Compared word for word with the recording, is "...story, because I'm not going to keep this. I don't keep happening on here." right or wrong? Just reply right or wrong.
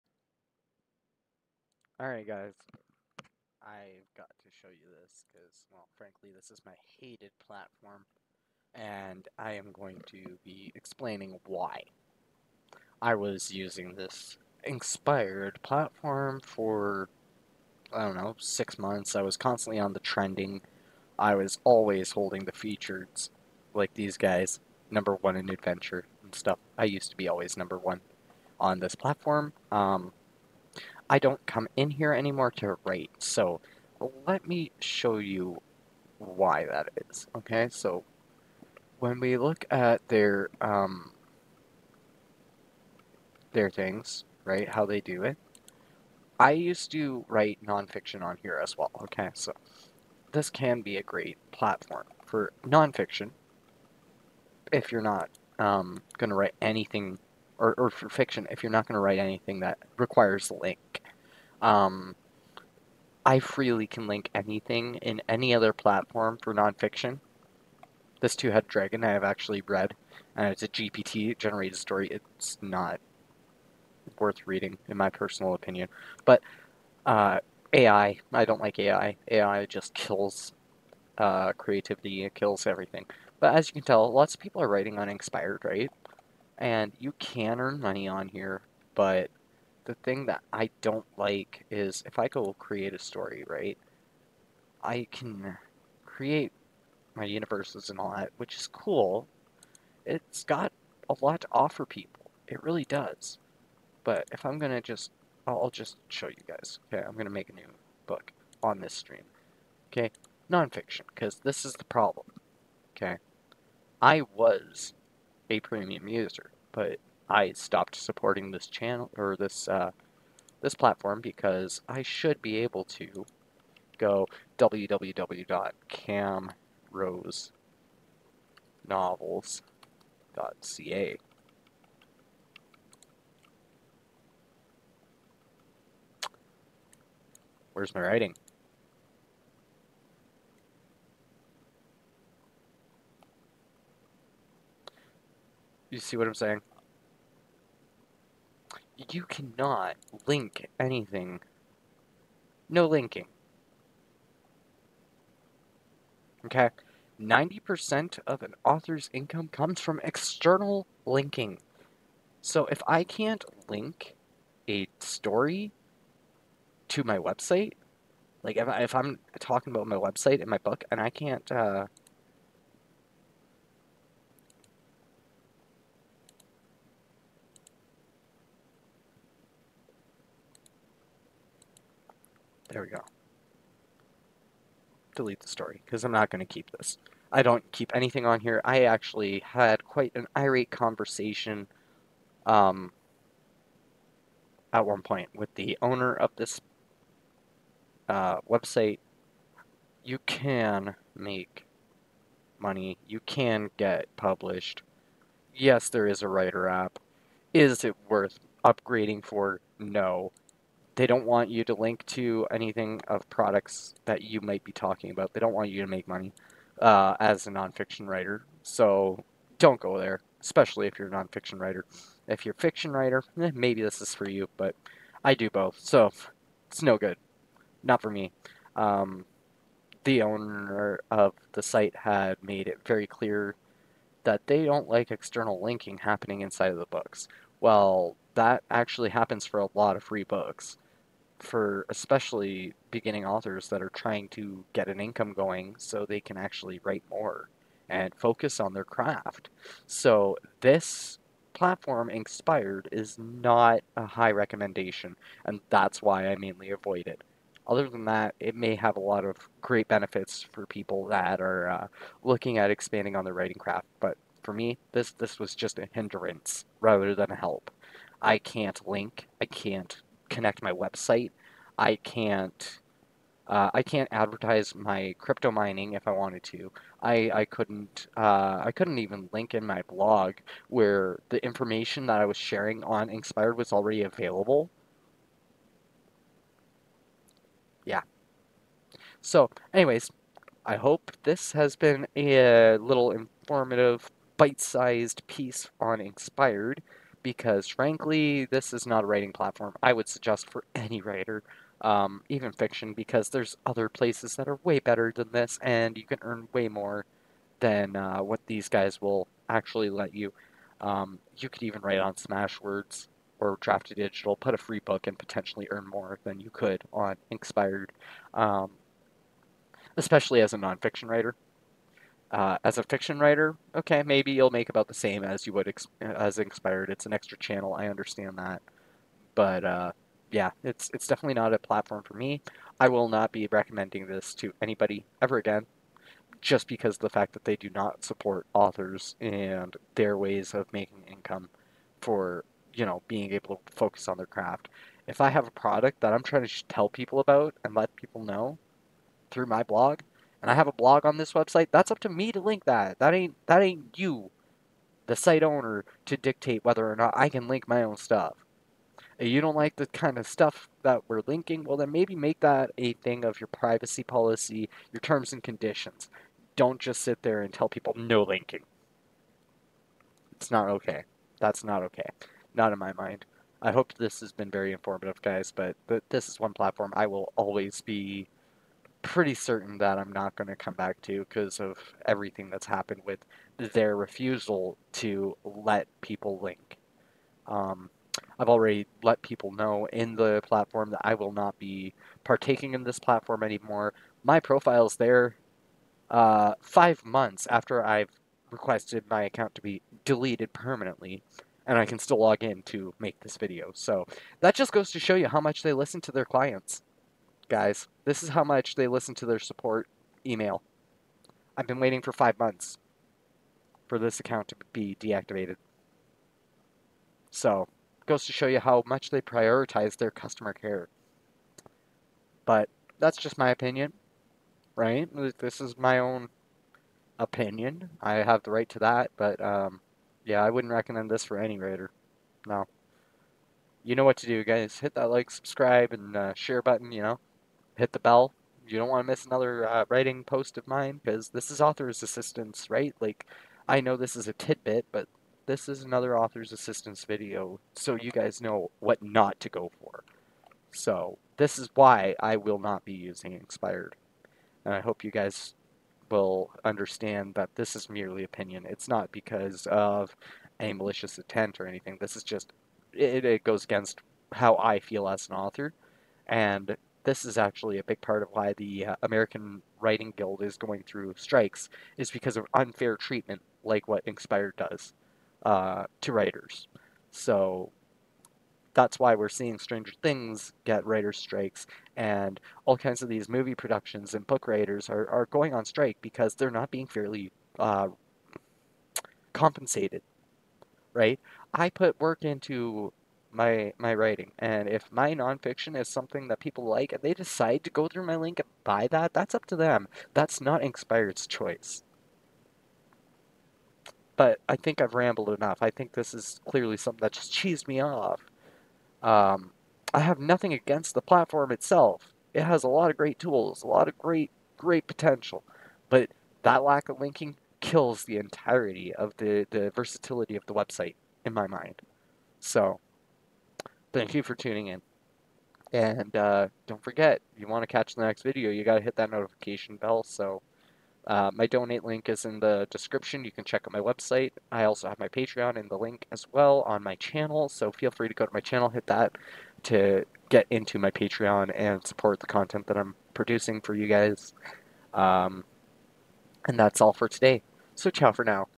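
wrong.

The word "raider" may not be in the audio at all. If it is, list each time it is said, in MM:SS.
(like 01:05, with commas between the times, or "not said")
07:11.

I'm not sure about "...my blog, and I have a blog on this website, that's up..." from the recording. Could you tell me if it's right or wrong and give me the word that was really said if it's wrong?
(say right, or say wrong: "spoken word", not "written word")
right.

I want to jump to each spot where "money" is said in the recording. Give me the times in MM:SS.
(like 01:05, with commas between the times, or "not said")
01:27, 03:22, 03:36.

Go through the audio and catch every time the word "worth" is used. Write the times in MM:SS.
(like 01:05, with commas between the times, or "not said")
01:14, 03:28.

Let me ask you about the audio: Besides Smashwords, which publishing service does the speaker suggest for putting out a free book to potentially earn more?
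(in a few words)
Draft to Digital.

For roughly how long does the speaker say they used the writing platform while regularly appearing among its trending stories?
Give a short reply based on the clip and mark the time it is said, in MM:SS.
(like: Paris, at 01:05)
6 months, at 00:18.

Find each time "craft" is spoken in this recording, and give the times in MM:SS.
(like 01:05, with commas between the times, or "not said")
04:08, 04:23, 05:44.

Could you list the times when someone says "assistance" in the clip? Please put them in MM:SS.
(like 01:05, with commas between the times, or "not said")
07:22, 07:26.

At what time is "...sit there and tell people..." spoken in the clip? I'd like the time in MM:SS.
06:07.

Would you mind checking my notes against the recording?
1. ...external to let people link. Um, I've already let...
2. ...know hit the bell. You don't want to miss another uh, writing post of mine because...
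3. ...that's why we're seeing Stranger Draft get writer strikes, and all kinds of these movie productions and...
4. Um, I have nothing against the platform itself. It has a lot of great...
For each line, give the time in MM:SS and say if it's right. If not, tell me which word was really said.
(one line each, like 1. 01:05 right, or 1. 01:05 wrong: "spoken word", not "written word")
1. 06:23 wrong: "refusal", not "external"
2. 07:17 right
3. 07:58 wrong: "Things", not "Draft"
4. 08:29 right.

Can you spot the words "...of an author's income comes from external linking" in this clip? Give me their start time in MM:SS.
02:38.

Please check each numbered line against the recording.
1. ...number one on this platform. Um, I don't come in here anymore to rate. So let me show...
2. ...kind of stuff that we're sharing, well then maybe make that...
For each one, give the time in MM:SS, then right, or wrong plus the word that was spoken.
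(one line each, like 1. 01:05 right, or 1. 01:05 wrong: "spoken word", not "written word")
1. 00:27 right
2. 05:59 wrong: "linking", not "sharing".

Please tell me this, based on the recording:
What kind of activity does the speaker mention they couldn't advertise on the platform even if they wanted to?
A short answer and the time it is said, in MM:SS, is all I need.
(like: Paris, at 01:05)
crypto mining, at 04:35.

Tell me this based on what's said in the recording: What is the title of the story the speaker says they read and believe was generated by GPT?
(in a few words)
Two-Headed Dragon.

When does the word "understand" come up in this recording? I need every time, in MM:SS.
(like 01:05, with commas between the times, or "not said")
05:27, 07:36.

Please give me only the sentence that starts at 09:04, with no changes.
Um, and that's all for today.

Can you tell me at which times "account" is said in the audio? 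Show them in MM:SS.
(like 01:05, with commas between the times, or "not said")
06:39, 06:54.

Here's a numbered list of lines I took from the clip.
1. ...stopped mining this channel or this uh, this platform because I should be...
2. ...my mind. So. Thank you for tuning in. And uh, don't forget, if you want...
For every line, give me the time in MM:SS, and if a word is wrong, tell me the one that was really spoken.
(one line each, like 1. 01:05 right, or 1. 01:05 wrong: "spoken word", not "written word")
1. 01:57 wrong: "supporting", not "mining"
2. 08:41 right.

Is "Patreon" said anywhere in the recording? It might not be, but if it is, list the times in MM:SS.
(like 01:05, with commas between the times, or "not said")
08:55, 09:00.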